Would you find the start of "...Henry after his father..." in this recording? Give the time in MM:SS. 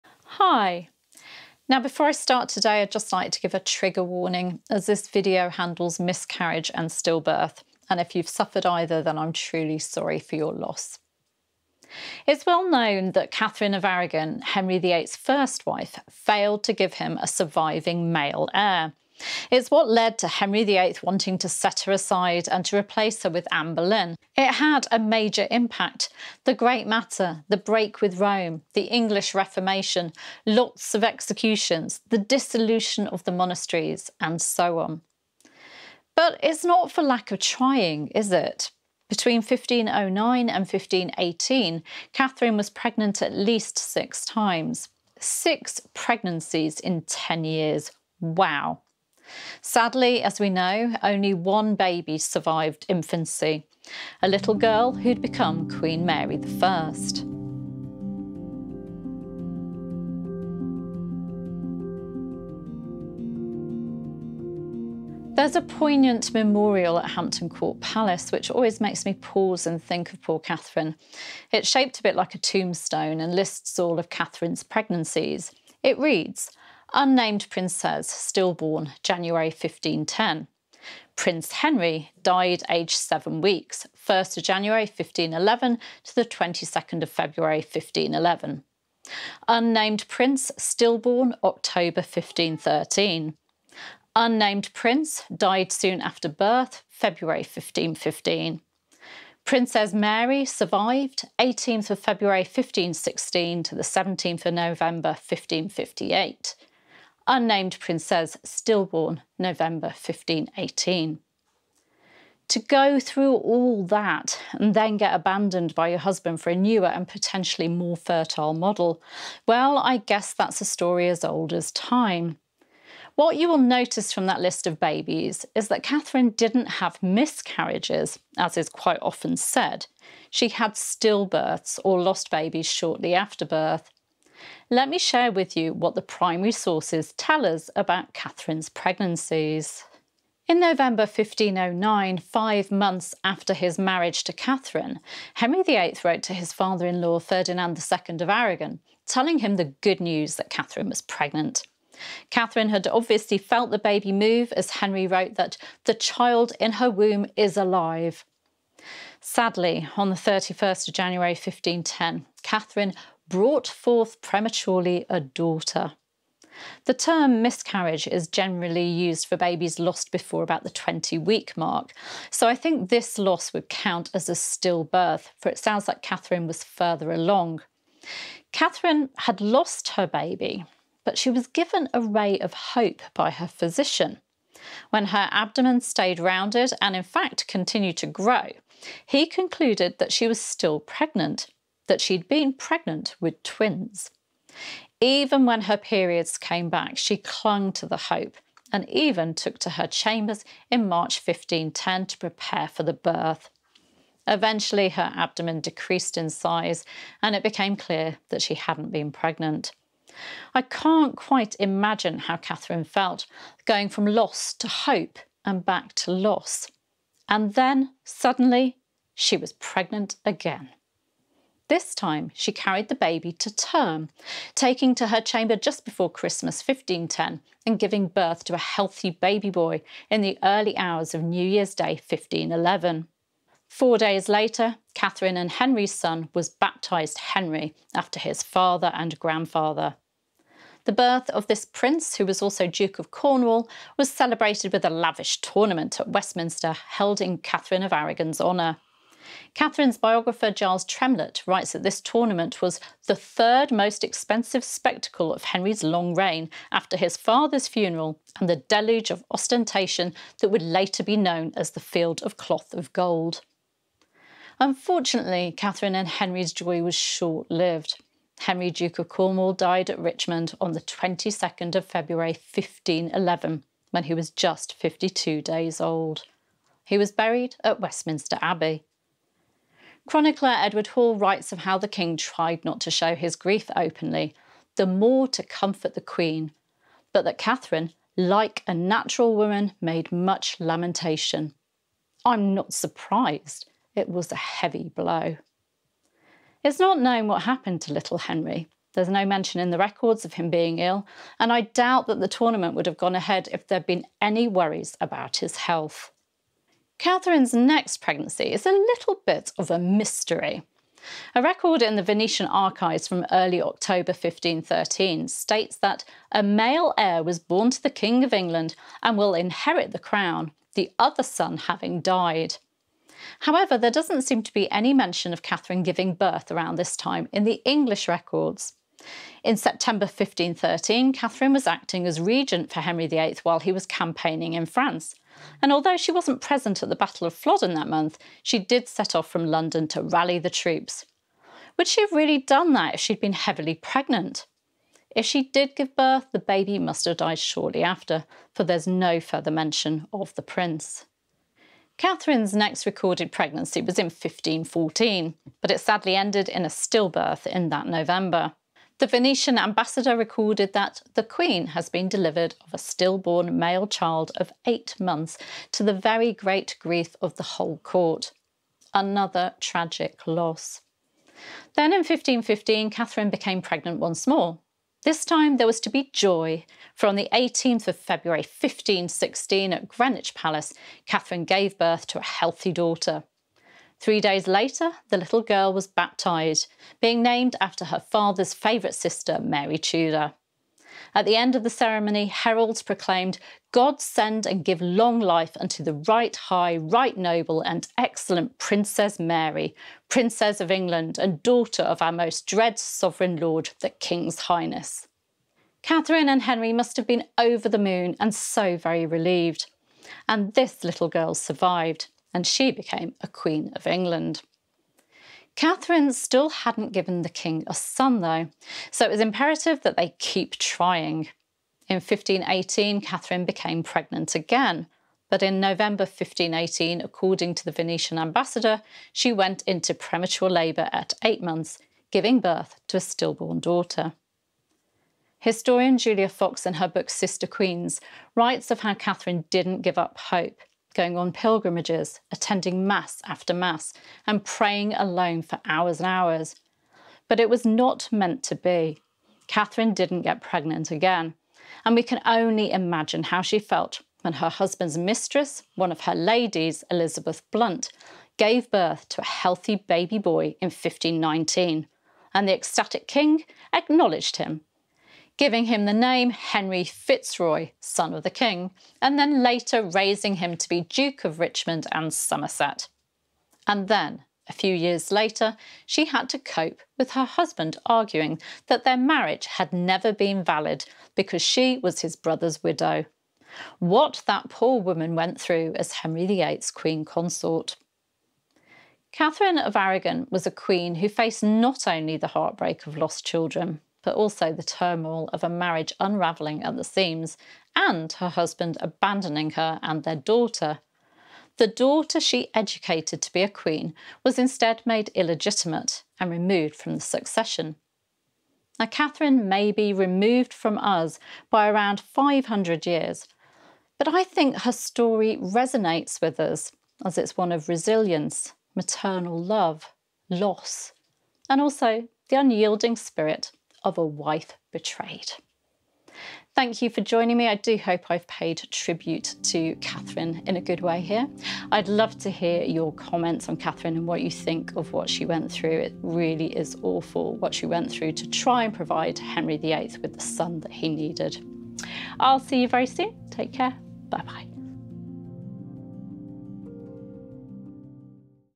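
03:57.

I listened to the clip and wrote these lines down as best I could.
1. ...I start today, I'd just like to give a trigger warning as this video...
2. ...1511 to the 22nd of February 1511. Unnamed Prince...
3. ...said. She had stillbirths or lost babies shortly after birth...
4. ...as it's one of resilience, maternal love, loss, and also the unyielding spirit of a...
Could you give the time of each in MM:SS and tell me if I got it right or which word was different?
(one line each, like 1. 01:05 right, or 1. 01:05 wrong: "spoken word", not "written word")
1. 00:02 right
2. 01:24 right
3. 02:09 right
4. 08:37 right.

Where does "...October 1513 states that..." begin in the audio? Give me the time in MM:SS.
05:13.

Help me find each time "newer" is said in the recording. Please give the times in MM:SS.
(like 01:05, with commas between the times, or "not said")
01:56.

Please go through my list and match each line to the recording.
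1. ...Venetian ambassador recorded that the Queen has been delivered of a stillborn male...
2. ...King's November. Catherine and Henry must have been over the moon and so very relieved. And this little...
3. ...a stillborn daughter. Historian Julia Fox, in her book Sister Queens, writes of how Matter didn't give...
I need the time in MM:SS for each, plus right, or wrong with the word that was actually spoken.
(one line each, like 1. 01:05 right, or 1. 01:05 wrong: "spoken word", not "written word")
1. 05:59 right
2. 06:43 wrong: "Highness", not "November"
3. 07:12 wrong: "Catherine", not "Matter".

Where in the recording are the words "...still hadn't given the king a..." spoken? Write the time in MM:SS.
06:56.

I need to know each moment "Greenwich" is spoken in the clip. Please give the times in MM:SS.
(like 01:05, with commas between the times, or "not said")
06:19.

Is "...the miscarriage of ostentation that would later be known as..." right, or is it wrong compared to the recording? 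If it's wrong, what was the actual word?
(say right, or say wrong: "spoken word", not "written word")
wrong: "deluge", not "miscarriage".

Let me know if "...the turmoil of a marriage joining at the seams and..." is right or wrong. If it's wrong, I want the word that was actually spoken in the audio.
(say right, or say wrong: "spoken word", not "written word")
wrong: "unravelling", not "joining".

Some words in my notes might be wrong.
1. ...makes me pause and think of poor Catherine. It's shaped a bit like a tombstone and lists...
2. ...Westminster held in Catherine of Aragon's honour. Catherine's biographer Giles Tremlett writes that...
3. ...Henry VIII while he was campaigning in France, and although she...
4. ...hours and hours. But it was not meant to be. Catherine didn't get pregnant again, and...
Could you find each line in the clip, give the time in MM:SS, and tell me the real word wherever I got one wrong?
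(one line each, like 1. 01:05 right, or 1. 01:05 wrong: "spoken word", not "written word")
1. 01:08 right
2. 04:06 right
3. 05:32 right
4. 07:25 right.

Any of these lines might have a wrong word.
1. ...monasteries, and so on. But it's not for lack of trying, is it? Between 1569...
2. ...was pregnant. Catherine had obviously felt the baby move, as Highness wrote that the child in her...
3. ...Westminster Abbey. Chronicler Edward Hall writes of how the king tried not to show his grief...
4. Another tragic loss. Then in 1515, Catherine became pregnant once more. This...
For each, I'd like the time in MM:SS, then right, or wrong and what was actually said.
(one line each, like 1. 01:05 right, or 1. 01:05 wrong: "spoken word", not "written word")
1. 00:33 wrong: "1509", not "1569"
2. 02:30 wrong: "Henry", not "Highness"
3. 04:37 right
4. 06:08 right.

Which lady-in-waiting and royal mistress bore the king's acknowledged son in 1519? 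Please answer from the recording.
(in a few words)
Elizabeth Blunt.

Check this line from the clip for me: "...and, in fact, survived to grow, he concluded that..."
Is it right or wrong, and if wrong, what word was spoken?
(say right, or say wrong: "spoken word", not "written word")
wrong: "continued", not "survived".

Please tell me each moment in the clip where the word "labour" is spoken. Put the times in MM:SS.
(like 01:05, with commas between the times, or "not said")
07:10.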